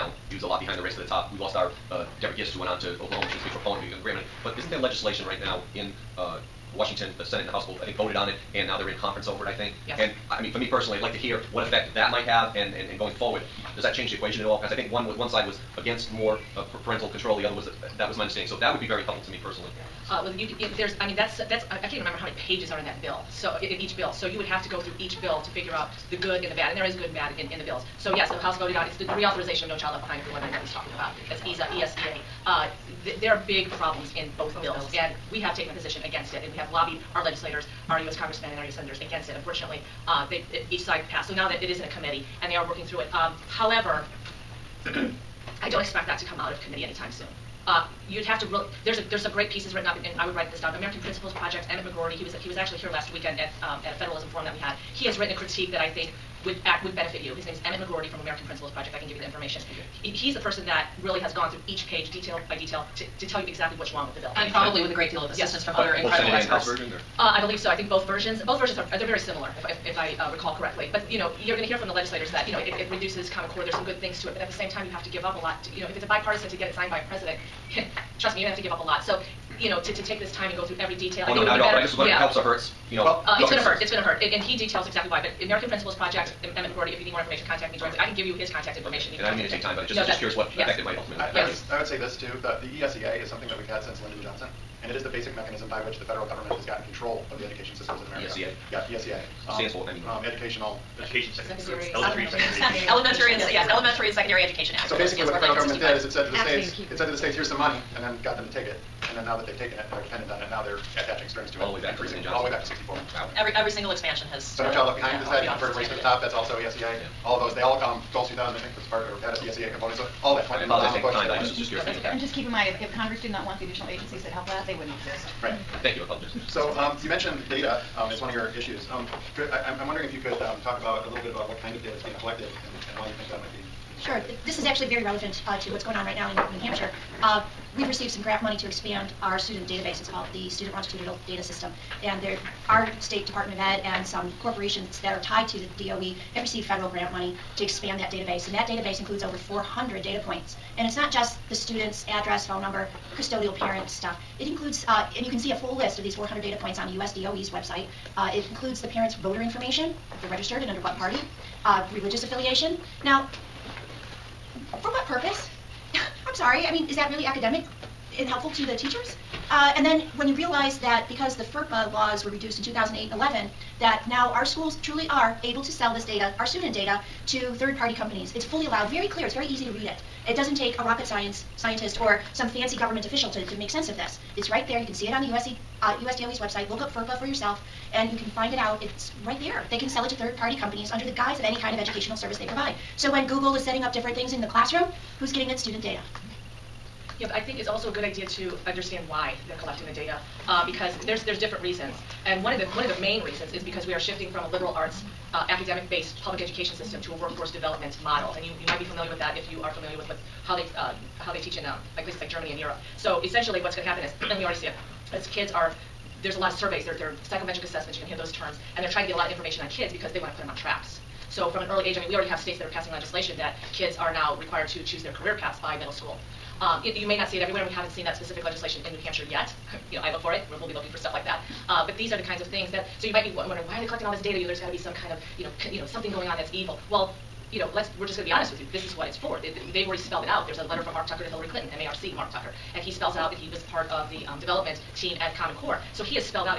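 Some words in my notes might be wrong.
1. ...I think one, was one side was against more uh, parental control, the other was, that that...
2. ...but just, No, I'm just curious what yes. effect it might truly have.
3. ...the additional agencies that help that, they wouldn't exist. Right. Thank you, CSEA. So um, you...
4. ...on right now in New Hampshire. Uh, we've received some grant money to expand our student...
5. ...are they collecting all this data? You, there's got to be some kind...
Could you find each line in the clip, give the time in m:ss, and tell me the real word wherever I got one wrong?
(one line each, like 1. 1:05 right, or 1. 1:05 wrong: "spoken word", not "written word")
1. 0:14 right
2. 1:29 wrong: "ultimately", not "truly"
3. 2:03 wrong: "Apologies", not "CSEA"
4. 2:15 right
5. 3:53 right.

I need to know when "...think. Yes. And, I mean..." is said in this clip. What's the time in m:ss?
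0:09.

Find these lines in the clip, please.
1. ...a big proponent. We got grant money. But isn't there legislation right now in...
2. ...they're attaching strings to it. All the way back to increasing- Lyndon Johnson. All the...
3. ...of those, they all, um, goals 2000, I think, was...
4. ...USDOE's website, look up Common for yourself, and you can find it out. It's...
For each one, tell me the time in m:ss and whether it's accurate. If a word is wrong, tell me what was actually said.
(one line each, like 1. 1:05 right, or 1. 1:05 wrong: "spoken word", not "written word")
1. 0:03 right
2. 1:50 right
3. 1:57 right
4. 3:06 wrong: "FERPA", not "Common".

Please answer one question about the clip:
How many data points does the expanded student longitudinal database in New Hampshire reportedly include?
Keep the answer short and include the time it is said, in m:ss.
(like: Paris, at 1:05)
Over 400, at 2:29.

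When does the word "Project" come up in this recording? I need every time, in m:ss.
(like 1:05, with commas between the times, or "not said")
0:51, 0:58, 1:25.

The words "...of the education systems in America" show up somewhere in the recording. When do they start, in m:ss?
1:37.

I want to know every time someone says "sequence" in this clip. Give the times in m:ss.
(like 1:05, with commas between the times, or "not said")
not said.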